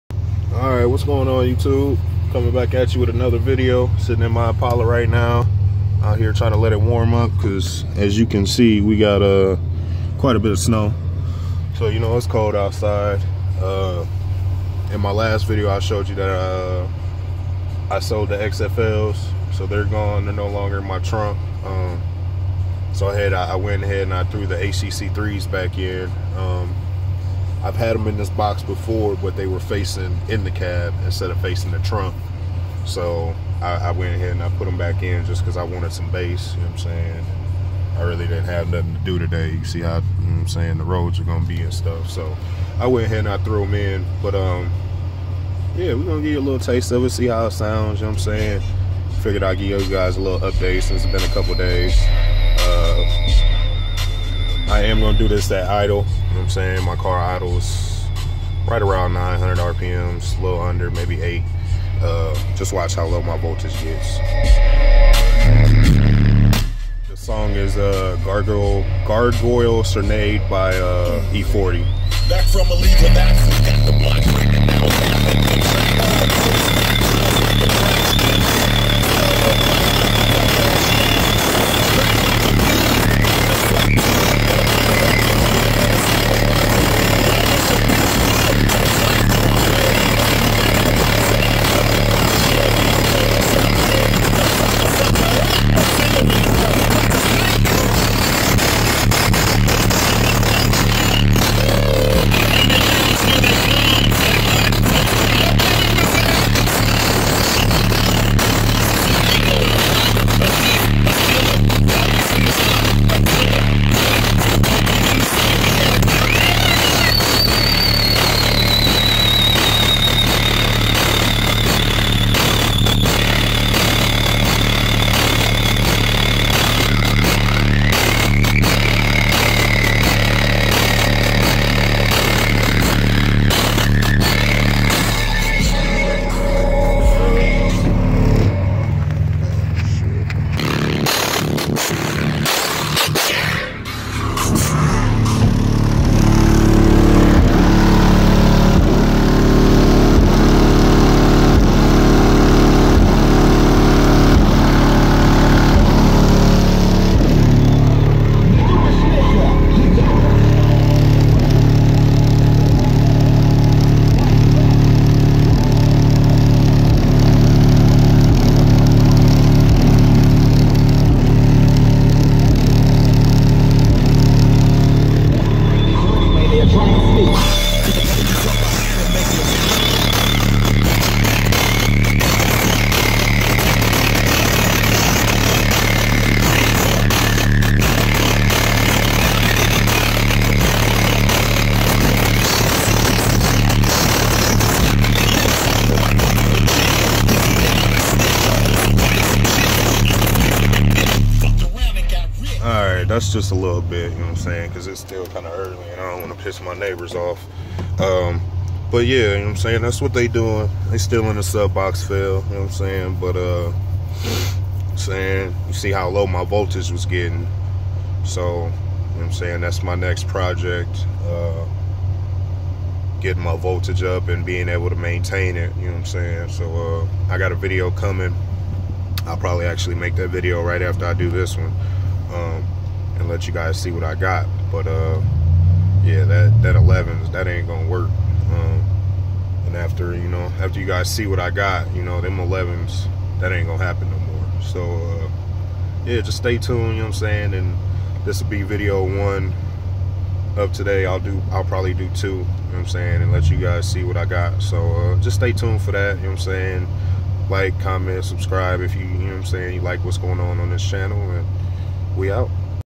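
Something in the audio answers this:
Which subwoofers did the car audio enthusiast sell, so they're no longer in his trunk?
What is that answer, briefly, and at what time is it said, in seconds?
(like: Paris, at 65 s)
XFLs, at 18 s.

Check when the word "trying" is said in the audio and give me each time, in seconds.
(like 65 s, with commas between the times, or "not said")
6 s.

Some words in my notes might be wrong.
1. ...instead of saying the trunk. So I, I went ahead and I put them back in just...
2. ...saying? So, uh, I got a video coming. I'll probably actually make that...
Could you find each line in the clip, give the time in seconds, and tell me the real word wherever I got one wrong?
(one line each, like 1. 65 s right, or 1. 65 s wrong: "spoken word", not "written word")
1. 31 s wrong: "facing", not "saying"
2. 226 s right.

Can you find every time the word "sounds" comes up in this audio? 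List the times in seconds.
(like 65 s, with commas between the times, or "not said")
47 s.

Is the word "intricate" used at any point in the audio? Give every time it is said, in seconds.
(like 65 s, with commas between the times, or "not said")
not said.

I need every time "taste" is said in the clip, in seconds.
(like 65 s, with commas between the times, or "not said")
46 s.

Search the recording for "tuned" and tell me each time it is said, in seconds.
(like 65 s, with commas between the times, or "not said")
246 s, 255 s.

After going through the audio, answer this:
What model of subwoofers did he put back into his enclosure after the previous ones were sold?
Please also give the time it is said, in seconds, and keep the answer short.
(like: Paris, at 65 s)
HDC3s, at 24 s.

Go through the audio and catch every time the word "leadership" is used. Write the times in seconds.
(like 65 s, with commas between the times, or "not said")
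not said.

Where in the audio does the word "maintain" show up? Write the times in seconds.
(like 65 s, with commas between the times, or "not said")
224 s.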